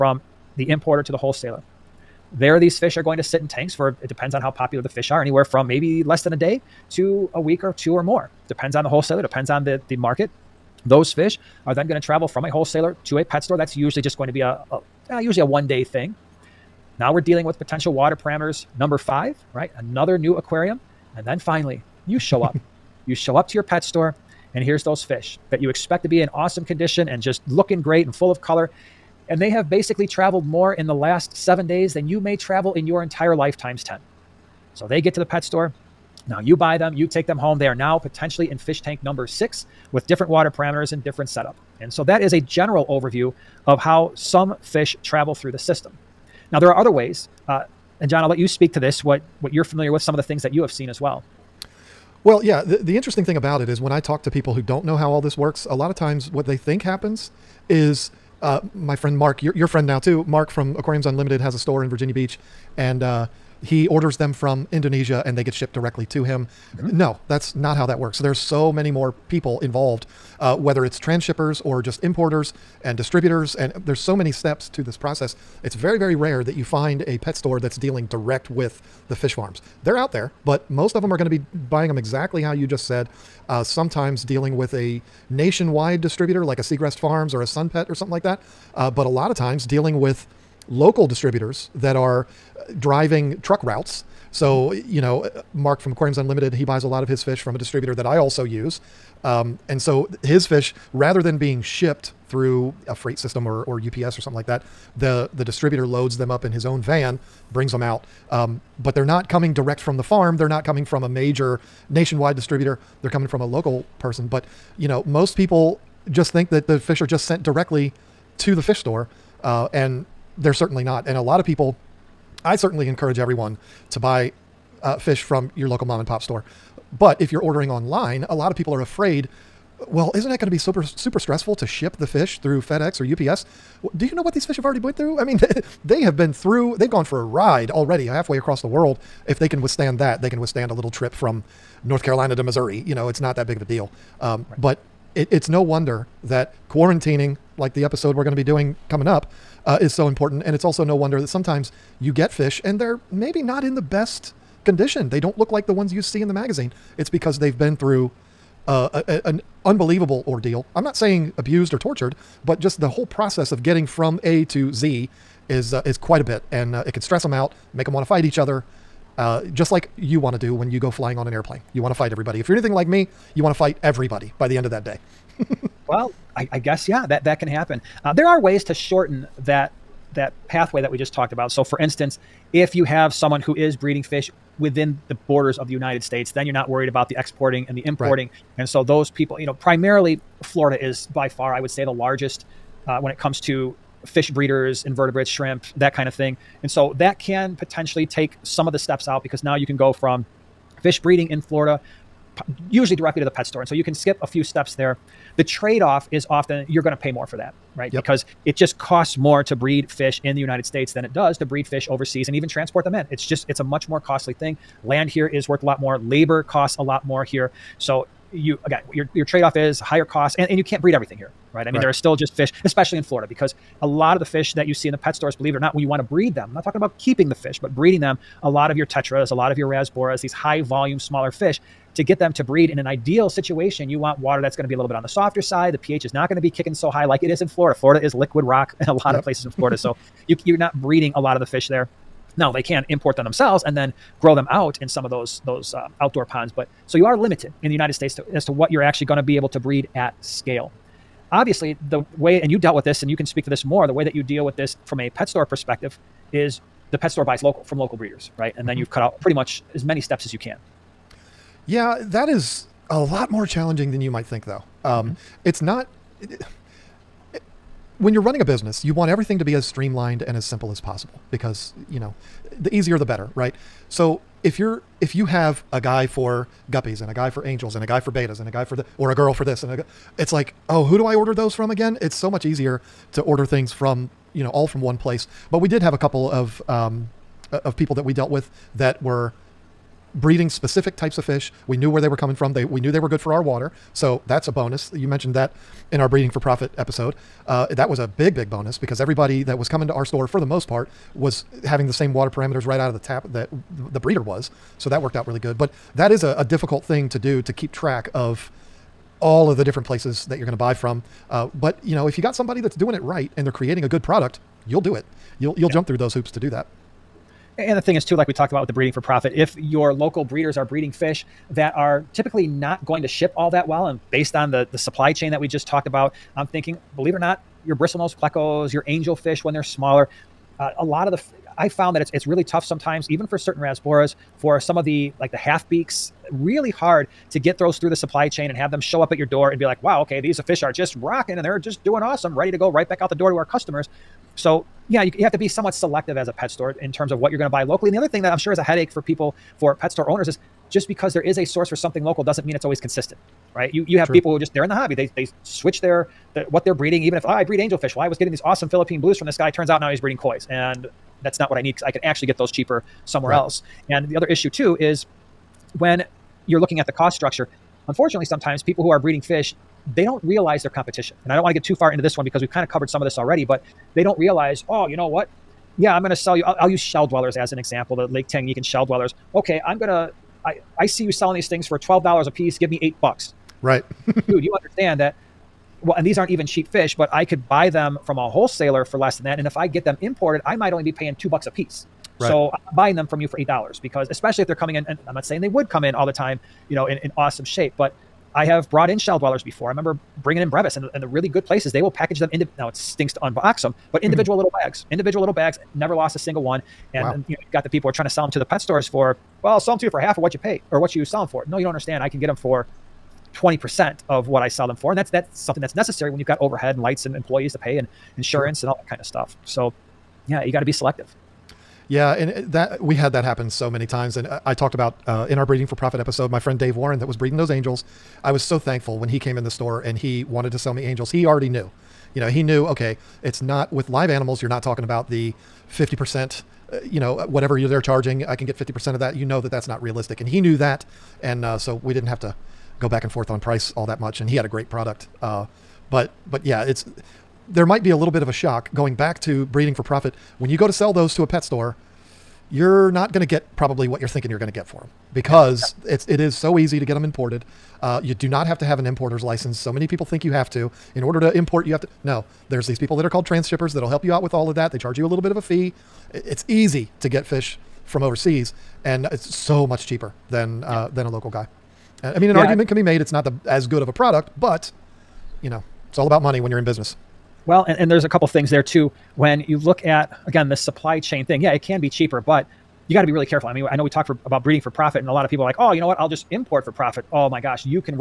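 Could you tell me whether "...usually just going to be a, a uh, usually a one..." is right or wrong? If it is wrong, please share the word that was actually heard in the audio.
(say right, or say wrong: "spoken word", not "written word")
right.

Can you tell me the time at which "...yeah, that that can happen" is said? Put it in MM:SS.
02:56.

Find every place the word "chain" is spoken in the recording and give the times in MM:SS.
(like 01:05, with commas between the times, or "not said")
05:25, 05:38, 08:00.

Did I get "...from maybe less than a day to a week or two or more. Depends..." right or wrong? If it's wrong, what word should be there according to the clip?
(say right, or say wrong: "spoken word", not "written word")
right.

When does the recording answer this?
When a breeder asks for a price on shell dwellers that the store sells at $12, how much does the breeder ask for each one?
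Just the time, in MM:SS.
06:22.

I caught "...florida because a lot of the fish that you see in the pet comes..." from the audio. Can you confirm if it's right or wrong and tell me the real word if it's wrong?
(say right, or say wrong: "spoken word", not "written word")
wrong: "stores", not "comes".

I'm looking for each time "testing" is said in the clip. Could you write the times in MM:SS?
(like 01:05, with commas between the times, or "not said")
not said.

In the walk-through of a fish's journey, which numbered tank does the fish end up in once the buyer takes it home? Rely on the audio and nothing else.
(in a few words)
6.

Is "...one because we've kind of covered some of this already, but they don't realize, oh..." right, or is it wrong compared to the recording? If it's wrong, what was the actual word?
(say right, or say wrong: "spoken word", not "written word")
right.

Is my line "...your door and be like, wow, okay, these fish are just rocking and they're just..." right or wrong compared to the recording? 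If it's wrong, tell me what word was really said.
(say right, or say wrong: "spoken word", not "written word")
right.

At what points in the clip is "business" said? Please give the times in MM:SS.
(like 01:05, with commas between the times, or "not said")
04:28, 07:56.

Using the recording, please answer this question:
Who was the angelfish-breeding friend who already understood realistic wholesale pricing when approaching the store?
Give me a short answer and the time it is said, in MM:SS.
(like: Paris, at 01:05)
Dave Warren, at 07:06.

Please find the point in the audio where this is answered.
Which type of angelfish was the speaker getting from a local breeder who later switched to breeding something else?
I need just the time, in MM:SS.
05:58.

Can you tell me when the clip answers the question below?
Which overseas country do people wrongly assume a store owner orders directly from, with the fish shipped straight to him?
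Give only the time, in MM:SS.
01:04.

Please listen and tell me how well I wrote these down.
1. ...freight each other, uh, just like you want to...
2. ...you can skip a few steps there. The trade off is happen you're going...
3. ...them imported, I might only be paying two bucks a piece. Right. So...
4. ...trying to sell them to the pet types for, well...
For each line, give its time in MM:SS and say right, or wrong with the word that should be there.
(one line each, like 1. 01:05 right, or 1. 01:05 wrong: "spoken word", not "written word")
1. 02:48 wrong: "fight", not "freight"
2. 03:23 wrong: "often", not "happen"
3. 06:29 right
4. 06:47 wrong: "stores", not "types".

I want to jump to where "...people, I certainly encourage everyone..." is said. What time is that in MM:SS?
02:01.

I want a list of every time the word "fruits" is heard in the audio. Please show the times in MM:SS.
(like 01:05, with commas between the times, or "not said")
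not said.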